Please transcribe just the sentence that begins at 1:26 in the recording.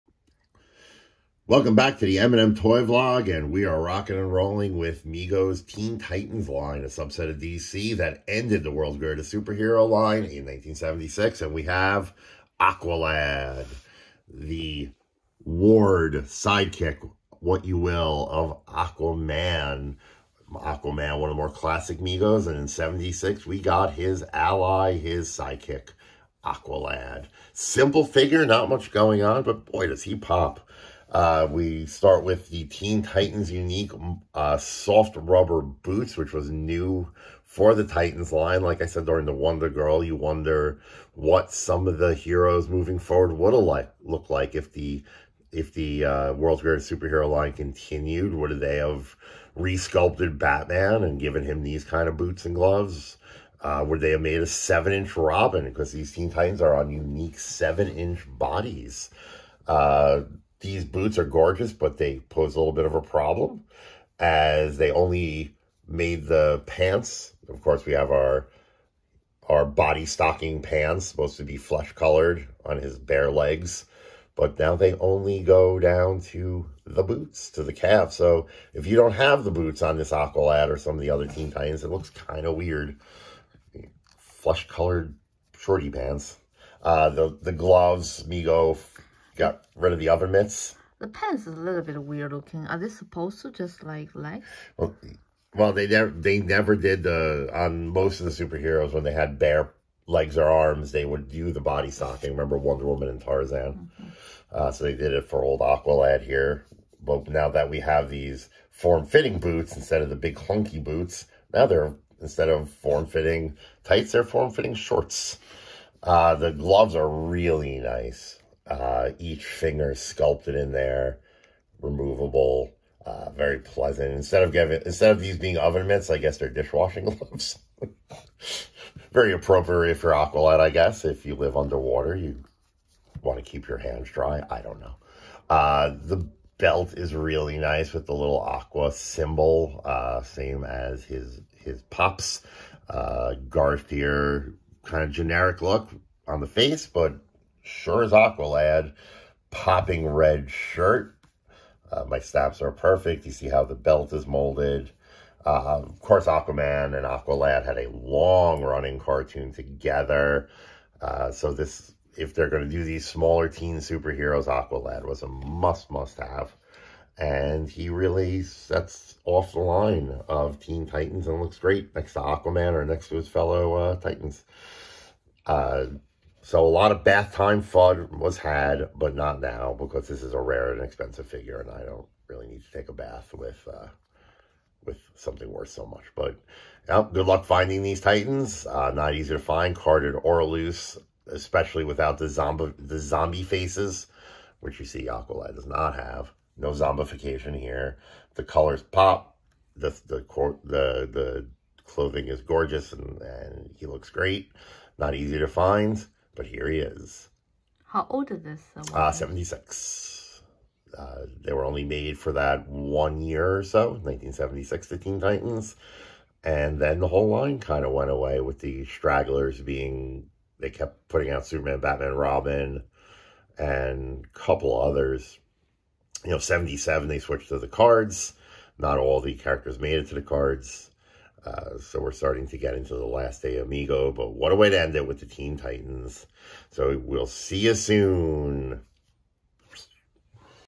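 Uh, the, the gloves, Mego Got rid of the oven mitts.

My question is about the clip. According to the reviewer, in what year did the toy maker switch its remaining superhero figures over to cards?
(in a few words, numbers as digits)
1977.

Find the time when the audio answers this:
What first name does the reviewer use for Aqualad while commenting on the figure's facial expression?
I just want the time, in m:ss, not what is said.
2:23.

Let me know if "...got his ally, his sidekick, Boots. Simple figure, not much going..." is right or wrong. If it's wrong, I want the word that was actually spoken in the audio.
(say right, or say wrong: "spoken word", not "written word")
wrong: "Aqualad", not "Boots".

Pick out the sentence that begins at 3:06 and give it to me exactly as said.
But yeah, good luck finding these Titans.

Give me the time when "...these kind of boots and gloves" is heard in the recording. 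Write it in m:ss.
0:51.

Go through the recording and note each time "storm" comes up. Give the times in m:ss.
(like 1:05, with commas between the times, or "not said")
not said.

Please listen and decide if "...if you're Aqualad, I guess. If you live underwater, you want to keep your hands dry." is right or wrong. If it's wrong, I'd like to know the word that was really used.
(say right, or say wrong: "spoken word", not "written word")
right.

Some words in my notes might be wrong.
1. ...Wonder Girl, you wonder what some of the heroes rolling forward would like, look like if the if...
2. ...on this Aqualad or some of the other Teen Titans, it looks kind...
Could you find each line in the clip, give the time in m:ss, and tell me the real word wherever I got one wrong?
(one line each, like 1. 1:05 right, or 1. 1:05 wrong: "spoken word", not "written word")
1. 0:39 wrong: "moving", not "rolling"
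2. 1:19 right.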